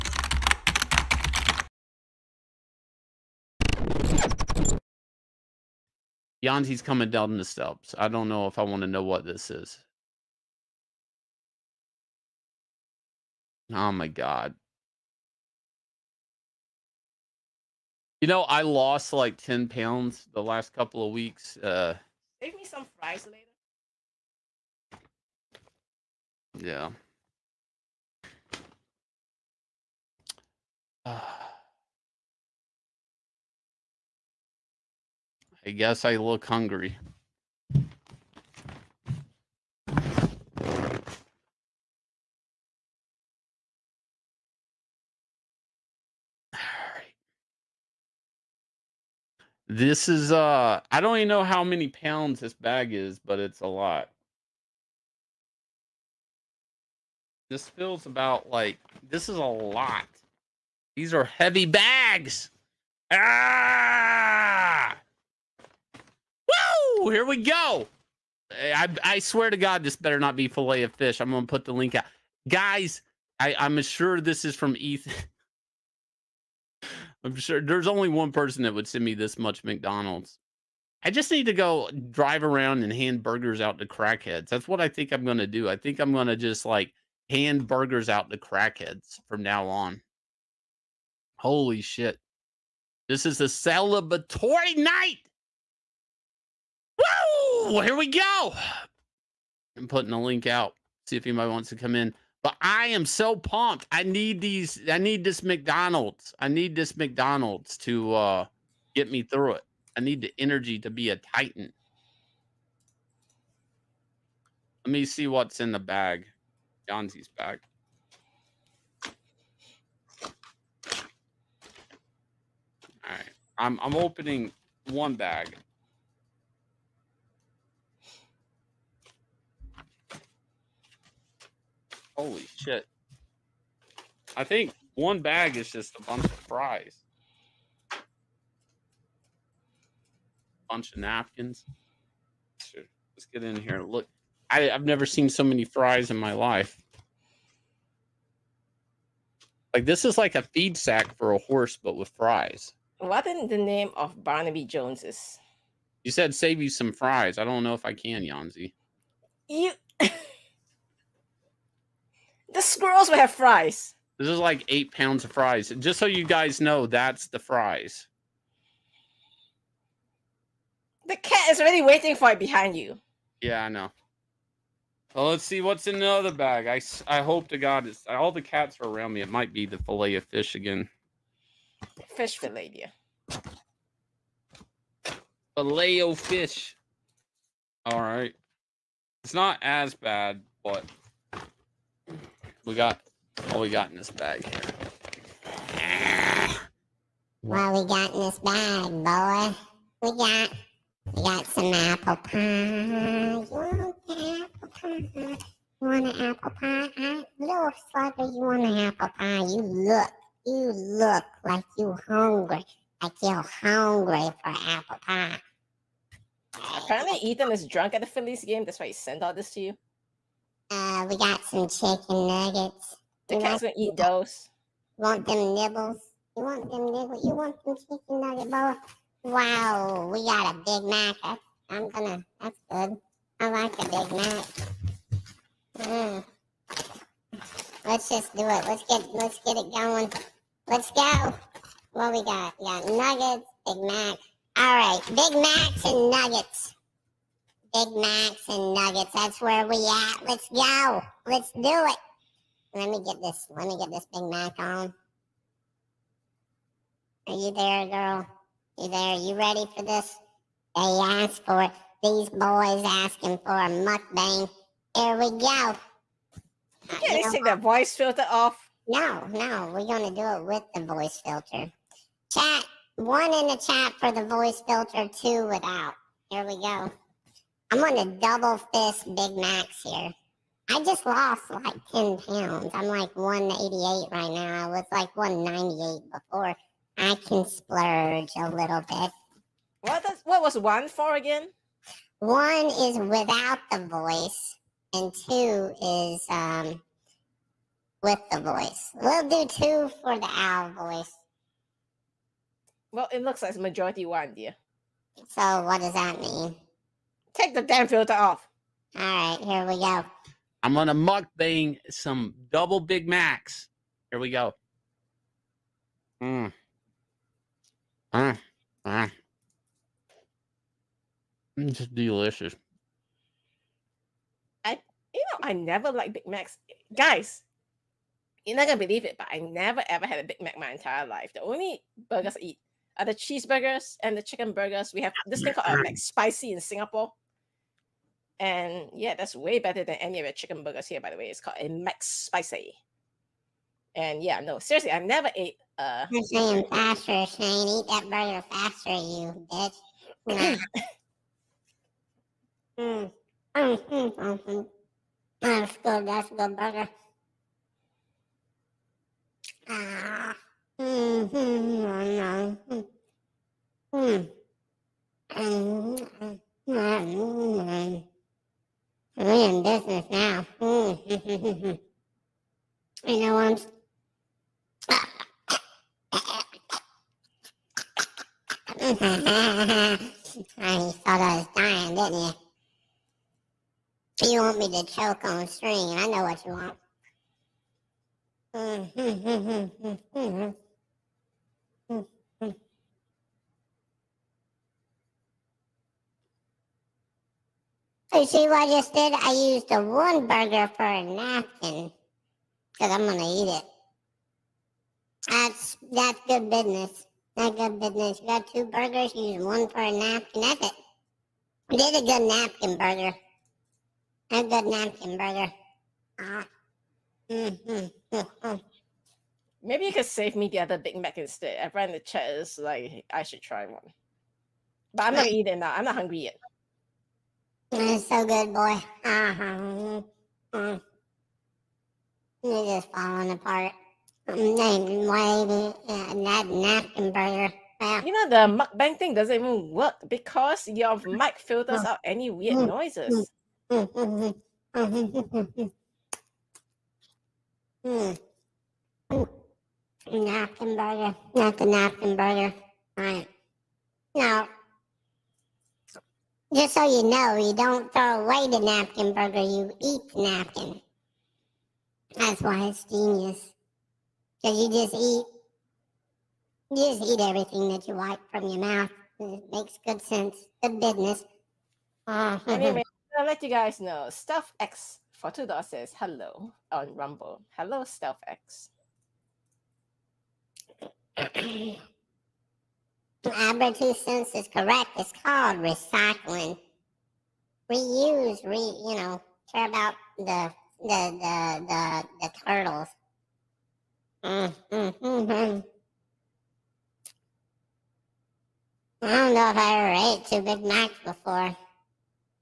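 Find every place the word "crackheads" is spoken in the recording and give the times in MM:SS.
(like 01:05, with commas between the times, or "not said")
01:23, 01:28.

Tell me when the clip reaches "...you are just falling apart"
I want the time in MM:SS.
07:12.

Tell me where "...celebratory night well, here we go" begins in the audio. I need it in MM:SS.
01:33.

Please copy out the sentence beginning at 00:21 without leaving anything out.
Uh save me some fries later.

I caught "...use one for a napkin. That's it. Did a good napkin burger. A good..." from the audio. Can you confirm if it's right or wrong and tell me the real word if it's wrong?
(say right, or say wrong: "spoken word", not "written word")
right.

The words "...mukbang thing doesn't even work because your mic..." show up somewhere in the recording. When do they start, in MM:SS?
07:18.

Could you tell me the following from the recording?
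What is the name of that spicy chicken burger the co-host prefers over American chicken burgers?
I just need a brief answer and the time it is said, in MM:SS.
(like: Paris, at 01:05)
Max Spicy, at 05:41.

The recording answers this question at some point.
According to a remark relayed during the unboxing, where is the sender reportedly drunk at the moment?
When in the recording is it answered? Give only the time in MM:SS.
03:38.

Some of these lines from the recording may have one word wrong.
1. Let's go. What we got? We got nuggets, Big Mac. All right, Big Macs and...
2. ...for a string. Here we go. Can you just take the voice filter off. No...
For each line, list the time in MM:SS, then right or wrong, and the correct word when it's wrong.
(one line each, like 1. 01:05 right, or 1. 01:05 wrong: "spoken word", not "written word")
1. 04:00 right
2. 04:23 wrong: "mukbang", not "string".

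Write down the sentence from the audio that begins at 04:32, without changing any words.
Chat one in the chat for the voice filter, two without.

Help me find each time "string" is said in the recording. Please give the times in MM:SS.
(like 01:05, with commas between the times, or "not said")
06:25.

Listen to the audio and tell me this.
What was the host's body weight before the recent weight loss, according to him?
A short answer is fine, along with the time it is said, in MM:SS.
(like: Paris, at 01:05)
198, at 04:45.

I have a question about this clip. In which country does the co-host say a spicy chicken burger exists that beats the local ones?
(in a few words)
Singapore.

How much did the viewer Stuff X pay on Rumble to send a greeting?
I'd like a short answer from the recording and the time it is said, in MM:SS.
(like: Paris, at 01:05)
$2, at 07:55.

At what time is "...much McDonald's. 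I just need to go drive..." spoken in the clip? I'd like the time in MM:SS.
01:19.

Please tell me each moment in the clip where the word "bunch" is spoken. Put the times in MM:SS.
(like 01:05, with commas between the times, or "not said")
02:16, 02:20.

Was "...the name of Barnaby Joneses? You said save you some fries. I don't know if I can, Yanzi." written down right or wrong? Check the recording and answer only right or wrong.
right.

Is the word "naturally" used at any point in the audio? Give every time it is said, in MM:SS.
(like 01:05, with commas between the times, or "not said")
not said.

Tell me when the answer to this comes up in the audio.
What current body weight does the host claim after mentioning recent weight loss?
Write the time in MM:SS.
04:43.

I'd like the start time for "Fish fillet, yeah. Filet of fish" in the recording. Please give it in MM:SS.
03:02.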